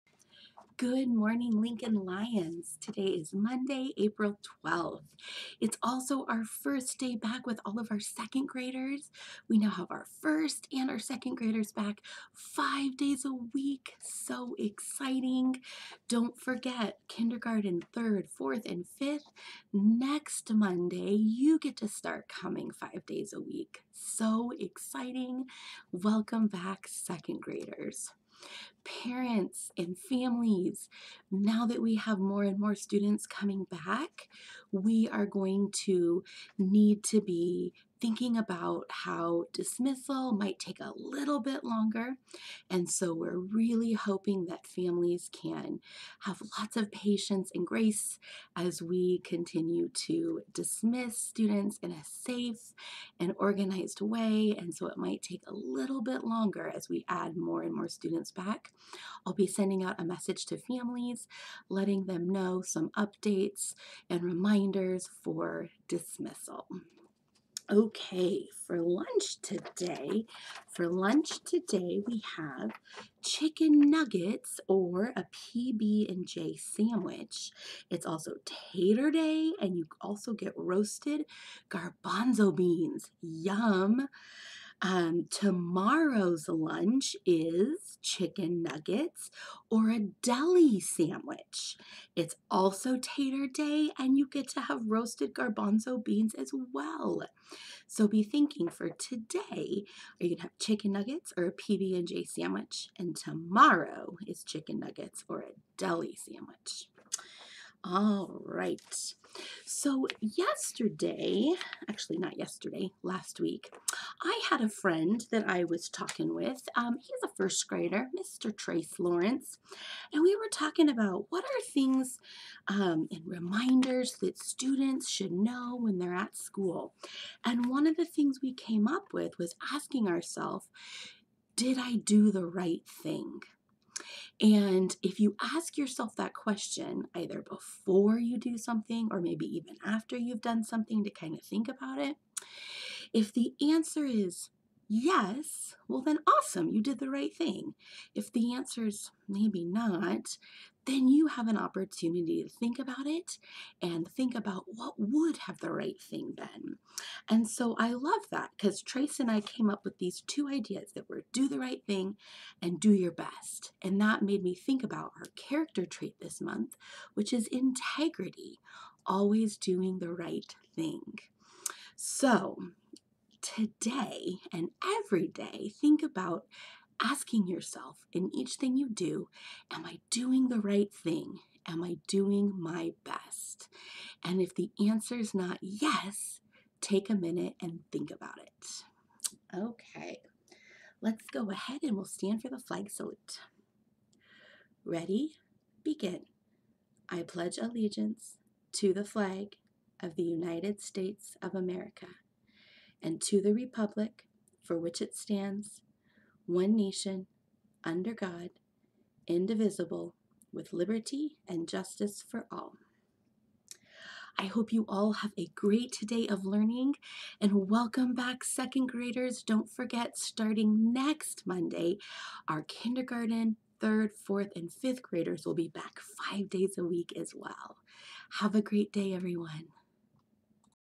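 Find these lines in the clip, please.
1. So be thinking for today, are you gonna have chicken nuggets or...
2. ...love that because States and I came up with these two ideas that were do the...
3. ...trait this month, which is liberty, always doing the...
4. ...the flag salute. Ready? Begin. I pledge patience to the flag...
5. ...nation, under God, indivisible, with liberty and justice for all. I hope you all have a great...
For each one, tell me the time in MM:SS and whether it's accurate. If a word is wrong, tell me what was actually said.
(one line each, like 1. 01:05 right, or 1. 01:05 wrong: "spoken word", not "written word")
1. 01:37 right
2. 02:37 wrong: "Trace", not "States"
3. 02:45 wrong: "integrity", not "liberty"
4. 03:12 wrong: "allegiance", not "patience"
5. 03:26 right.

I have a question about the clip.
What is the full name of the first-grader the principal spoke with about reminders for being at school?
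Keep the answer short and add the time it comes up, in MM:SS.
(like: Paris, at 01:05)
Trace Lawrence, at 01:58.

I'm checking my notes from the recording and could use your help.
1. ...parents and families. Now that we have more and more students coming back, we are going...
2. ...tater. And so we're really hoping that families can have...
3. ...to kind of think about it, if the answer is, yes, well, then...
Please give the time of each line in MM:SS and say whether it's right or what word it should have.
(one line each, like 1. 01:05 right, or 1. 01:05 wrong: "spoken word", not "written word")
1. 00:28 right
2. 00:41 wrong: "longer", not "tater"
3. 02:21 right.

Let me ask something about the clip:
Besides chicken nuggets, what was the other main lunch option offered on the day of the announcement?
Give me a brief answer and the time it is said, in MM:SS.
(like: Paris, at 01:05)
PB&J sandwich, at 01:15.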